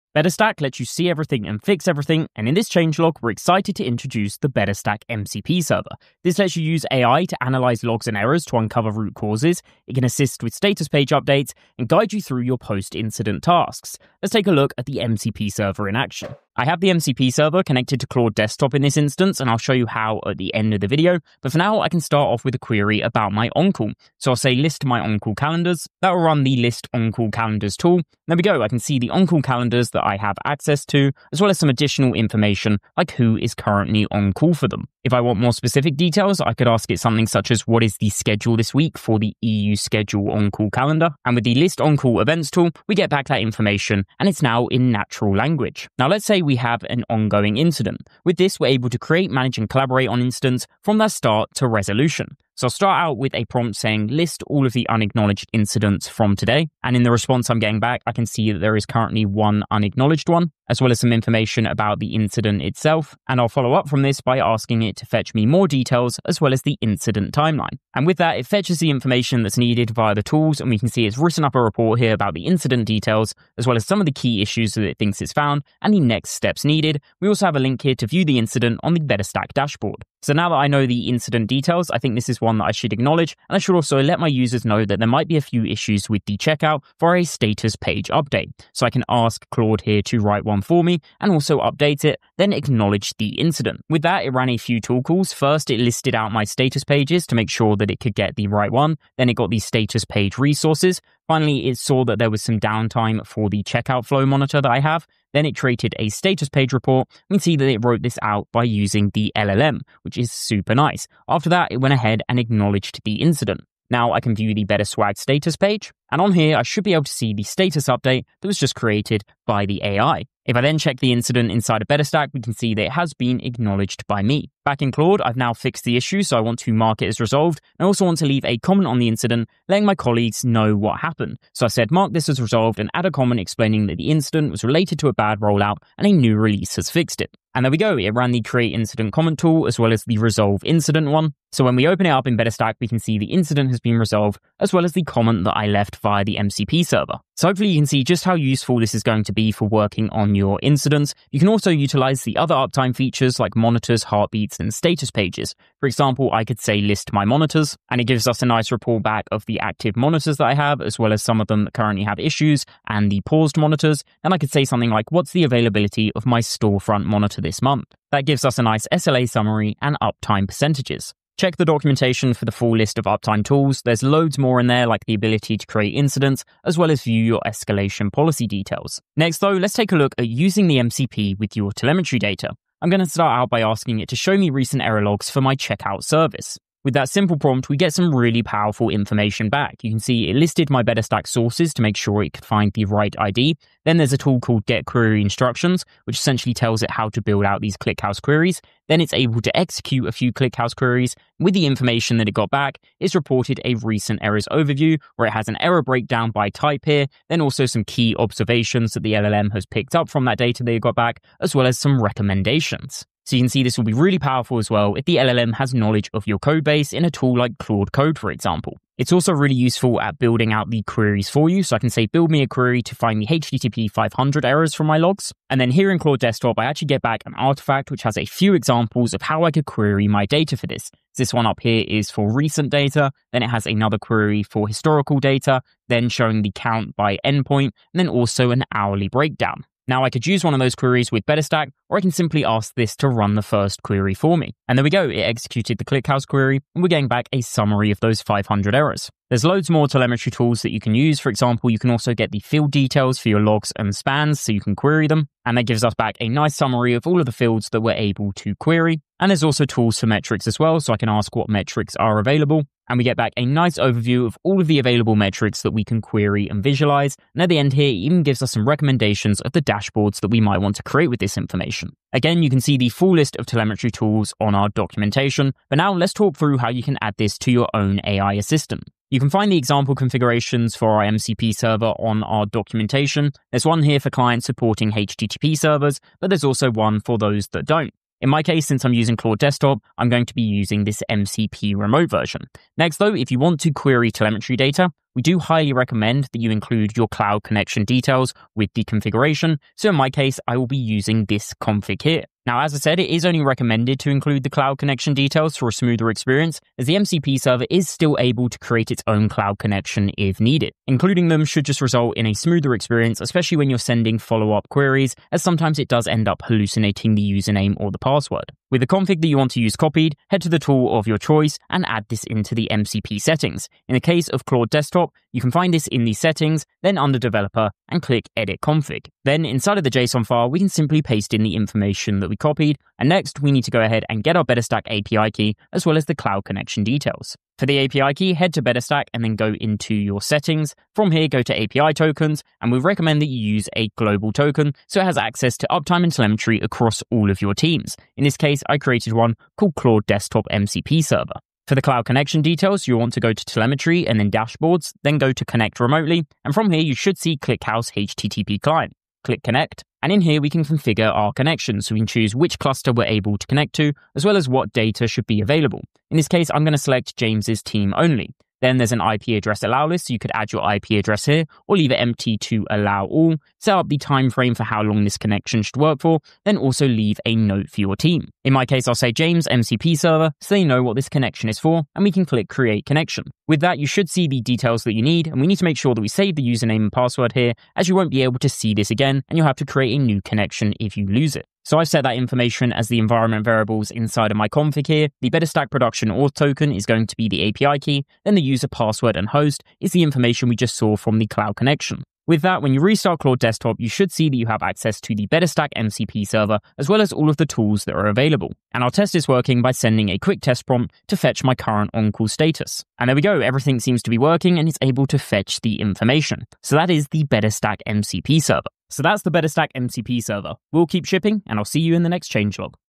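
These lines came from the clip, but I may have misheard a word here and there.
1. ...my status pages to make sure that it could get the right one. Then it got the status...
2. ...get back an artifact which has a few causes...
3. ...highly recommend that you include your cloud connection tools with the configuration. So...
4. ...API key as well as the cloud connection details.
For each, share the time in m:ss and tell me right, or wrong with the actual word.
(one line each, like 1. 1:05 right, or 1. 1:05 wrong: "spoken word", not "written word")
1. 1:36 right
2. 3:46 wrong: "examples", not "causes"
3. 4:55 wrong: "details", not "tools"
4. 5:34 right.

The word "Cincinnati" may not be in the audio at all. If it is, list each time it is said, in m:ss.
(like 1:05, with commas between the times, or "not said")
not said.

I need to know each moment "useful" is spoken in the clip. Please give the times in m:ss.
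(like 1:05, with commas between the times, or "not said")
2:28, 3:39.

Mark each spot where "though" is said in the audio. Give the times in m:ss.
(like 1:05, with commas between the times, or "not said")
2:59, 4:52.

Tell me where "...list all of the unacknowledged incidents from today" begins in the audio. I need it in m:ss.
0:54.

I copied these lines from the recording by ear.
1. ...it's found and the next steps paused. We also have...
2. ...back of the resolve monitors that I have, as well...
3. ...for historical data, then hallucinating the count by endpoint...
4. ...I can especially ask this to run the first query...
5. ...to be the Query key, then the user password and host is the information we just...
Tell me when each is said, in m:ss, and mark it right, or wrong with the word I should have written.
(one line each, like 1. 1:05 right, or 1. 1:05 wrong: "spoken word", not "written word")
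1. 1:15 wrong: "needed", not "paused"
2. 2:39 wrong: "active", not "resolve"
3. 3:54 wrong: "showing", not "hallucinating"
4. 4:01 wrong: "simply", not "especially"
5. 6:37 wrong: "API", not "Query".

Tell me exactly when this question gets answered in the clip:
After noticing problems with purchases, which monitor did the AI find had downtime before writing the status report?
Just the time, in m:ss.
1:43.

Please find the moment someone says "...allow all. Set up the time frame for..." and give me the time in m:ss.
6:12.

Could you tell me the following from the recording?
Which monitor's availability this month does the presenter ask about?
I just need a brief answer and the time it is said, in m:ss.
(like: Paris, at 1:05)
storefront monitor, at 2:46.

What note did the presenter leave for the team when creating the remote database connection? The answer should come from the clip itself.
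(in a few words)
James MCP server.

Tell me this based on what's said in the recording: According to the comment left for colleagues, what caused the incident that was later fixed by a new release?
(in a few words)
a bad rollout.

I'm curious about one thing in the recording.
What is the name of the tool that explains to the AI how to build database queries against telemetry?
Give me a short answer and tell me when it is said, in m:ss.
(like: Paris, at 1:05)
Get Query Instructions, at 3:14.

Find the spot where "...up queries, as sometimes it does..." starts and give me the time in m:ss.
5:14.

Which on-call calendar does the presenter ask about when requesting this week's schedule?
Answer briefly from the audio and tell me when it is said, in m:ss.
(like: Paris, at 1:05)
EU schedule, at 0:39.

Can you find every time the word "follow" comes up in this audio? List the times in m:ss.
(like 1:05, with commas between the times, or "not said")
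1:03, 5:14.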